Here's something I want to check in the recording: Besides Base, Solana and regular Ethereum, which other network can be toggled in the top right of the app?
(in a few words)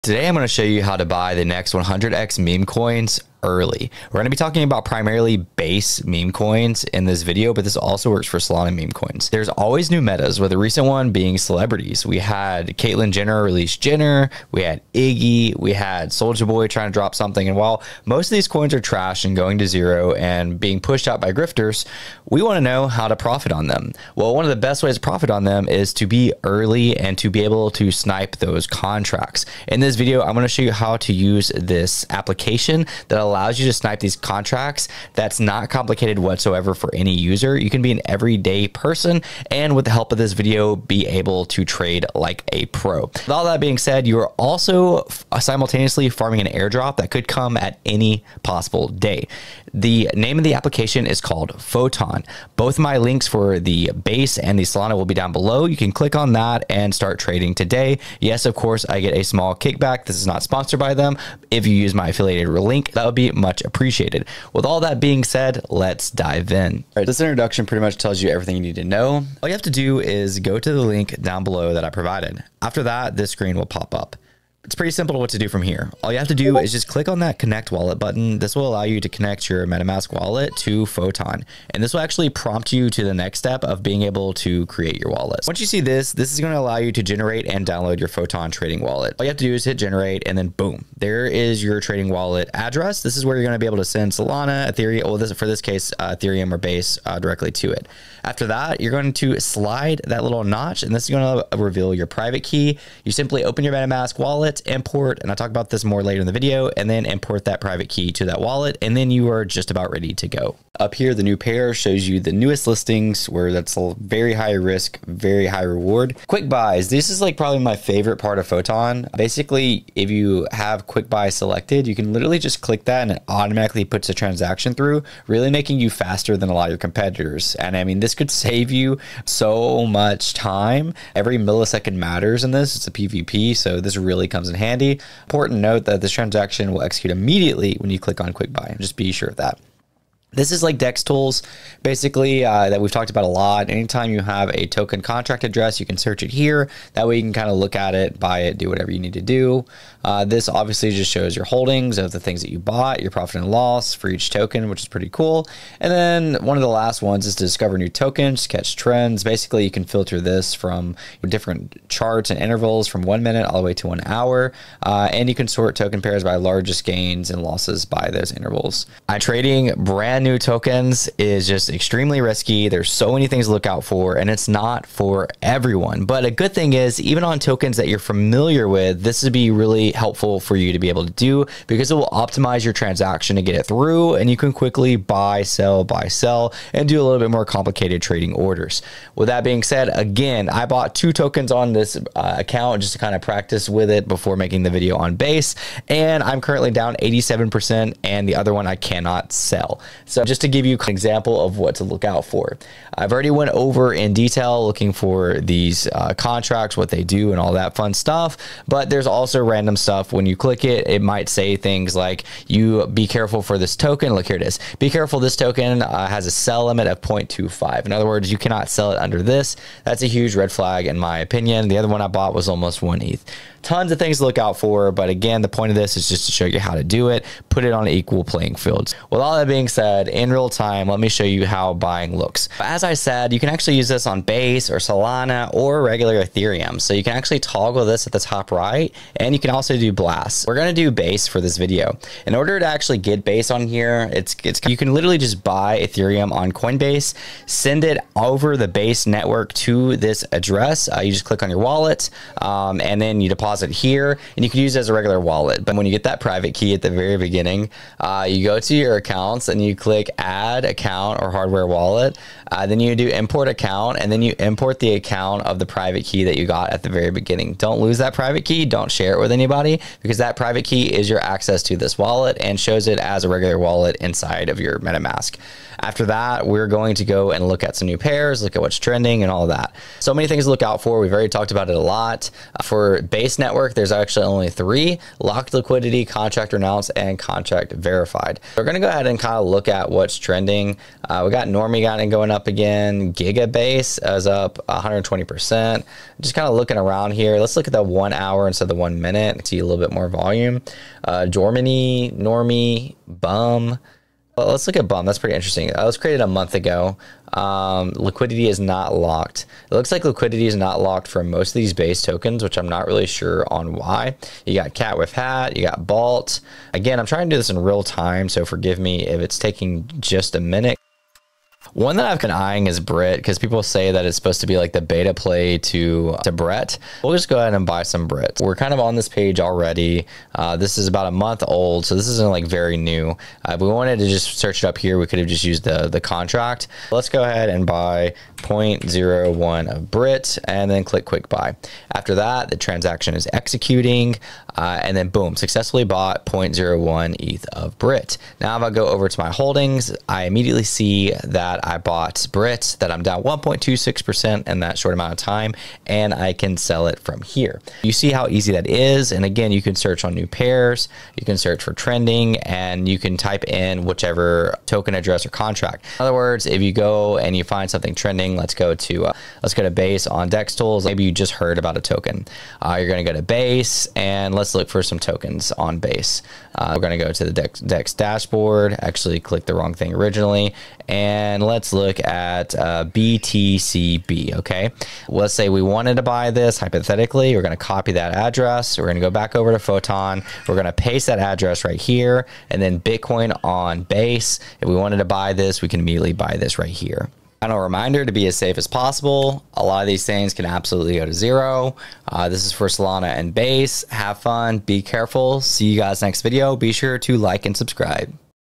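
Blast.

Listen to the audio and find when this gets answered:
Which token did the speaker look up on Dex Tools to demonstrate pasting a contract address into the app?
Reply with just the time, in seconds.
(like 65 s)
382 s.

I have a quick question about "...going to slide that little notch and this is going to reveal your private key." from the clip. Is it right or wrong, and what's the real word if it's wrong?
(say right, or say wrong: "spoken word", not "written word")
right.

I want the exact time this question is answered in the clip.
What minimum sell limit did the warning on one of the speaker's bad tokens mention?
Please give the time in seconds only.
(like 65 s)
216 s.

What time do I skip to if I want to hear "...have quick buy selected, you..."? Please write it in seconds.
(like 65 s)
120 s.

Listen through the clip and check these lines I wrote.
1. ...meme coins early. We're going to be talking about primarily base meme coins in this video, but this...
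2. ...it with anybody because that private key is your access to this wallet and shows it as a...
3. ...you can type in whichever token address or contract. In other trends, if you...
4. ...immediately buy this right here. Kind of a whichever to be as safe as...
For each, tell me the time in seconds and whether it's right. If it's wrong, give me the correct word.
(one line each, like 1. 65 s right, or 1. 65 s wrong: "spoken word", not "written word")
1. 2 s right
2. 269 s right
3. 362 s wrong: "words", not "trends"
4. 395 s wrong: "reminder", not "whichever".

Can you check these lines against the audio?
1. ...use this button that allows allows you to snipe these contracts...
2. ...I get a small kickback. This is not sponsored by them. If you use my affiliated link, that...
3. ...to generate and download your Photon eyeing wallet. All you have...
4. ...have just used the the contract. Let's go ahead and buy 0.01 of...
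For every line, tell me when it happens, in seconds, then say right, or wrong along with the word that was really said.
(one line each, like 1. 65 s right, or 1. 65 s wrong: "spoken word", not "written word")
1. 31 s wrong: "application", not "button"
2. 58 s right
3. 86 s wrong: "trading", not "eyeing"
4. 335 s right.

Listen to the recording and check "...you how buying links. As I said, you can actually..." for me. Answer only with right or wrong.
wrong.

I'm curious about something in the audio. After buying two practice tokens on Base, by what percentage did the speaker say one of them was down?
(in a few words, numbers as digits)
87%.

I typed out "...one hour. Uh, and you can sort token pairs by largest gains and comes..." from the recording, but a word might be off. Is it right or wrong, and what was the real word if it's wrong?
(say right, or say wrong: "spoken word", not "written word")
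wrong: "losses", not "comes".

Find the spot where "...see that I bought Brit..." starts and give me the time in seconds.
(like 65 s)
350 s.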